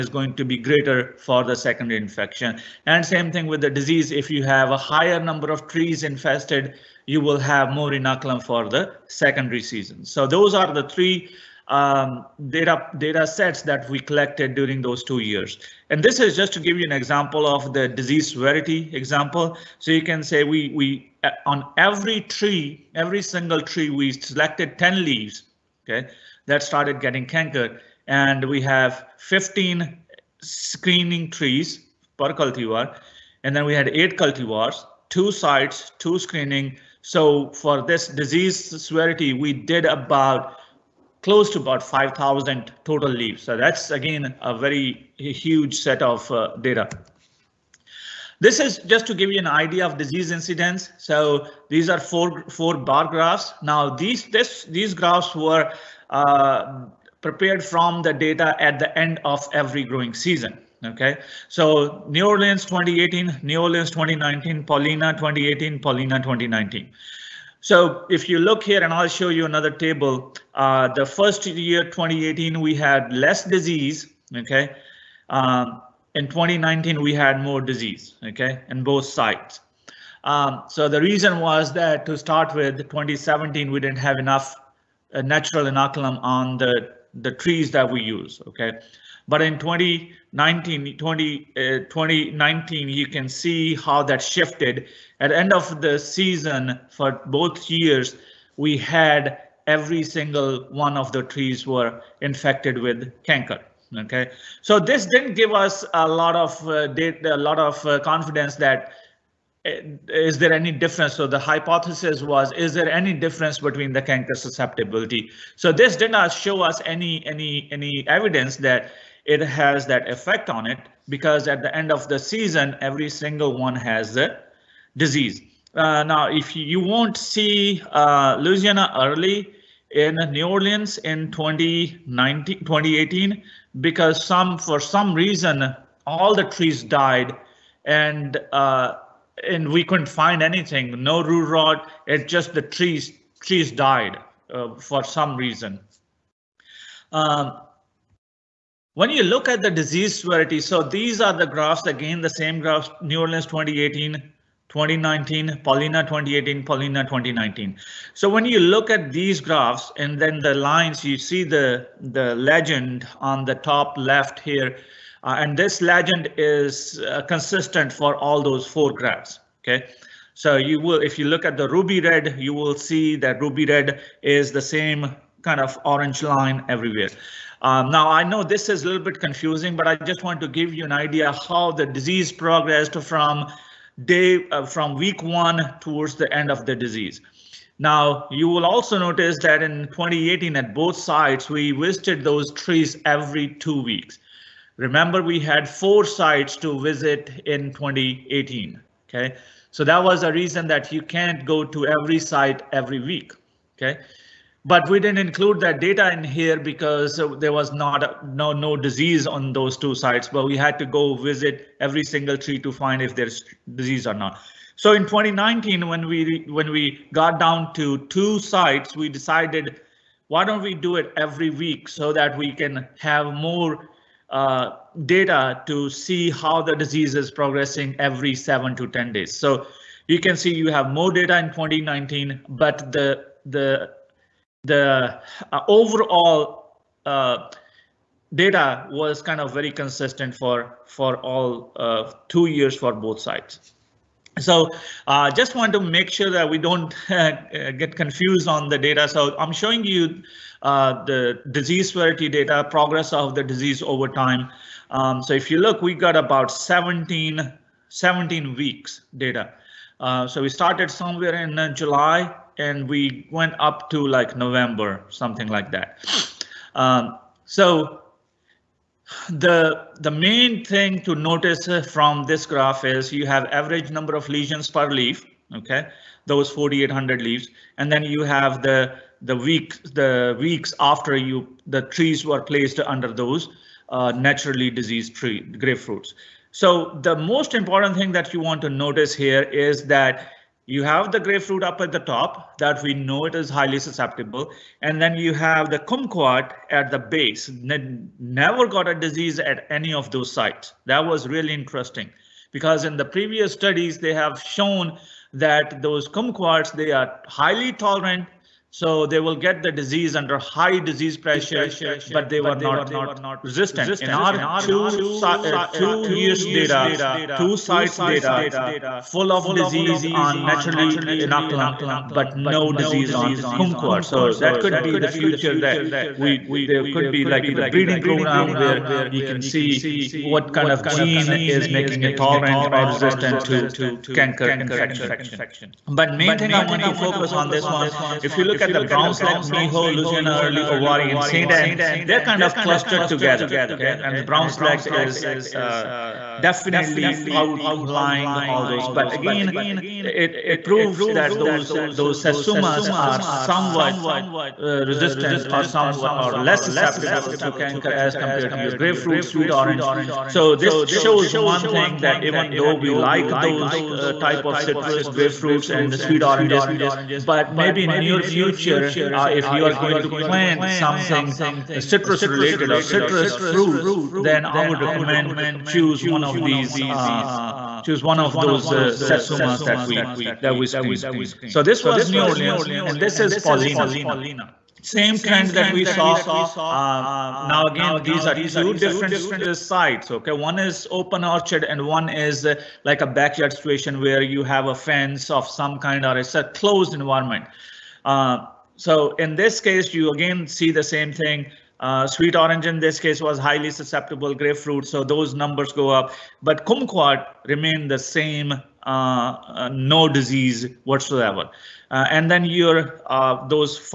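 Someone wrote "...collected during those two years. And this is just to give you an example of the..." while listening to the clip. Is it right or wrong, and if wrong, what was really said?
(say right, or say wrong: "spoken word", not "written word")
right.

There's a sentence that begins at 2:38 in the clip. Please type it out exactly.
So when you look at these graphs and then the lines, you see the, the legend on the top left here.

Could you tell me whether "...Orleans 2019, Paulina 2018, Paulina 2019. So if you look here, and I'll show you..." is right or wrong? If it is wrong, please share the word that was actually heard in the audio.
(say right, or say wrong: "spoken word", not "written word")
right.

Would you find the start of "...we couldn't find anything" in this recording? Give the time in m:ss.
2:19.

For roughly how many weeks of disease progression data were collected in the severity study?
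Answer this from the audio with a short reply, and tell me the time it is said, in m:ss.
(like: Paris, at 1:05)
17, at 4:17.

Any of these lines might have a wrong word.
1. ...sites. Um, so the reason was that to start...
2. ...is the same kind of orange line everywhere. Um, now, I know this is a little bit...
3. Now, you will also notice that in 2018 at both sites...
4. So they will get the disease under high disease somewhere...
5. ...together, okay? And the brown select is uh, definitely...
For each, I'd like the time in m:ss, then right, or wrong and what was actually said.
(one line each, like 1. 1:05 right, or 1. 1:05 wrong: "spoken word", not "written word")
1. 1:19 right
2. 2:54 right
3. 3:07 right
4. 5:08 wrong: "pressure", not "somewhere"
5. 5:43 right.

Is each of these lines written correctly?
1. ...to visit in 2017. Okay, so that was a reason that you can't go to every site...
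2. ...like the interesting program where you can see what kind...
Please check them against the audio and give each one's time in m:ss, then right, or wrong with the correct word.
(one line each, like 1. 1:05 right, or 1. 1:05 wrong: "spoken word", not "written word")
1. 3:16 wrong: "2018", not "2017"
2. 5:27 wrong: "breeding", not "interesting".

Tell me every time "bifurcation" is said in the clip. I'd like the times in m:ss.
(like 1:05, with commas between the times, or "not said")
not said.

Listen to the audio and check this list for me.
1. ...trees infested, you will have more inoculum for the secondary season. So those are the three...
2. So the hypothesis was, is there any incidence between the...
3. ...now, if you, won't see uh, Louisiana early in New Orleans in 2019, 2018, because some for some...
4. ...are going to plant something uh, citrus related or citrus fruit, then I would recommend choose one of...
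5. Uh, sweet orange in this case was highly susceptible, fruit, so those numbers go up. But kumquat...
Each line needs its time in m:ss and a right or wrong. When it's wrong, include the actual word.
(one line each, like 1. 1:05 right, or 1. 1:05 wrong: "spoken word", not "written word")
1. 0:05 right
2. 1:51 wrong: "difference", not "incidence"
3. 2:06 right
4. 6:09 right
5. 6:41 wrong: "grapefruit", not "fruit".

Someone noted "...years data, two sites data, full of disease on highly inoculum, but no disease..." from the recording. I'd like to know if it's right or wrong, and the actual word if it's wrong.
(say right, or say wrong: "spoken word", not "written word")
wrong: "naturally", not "highly".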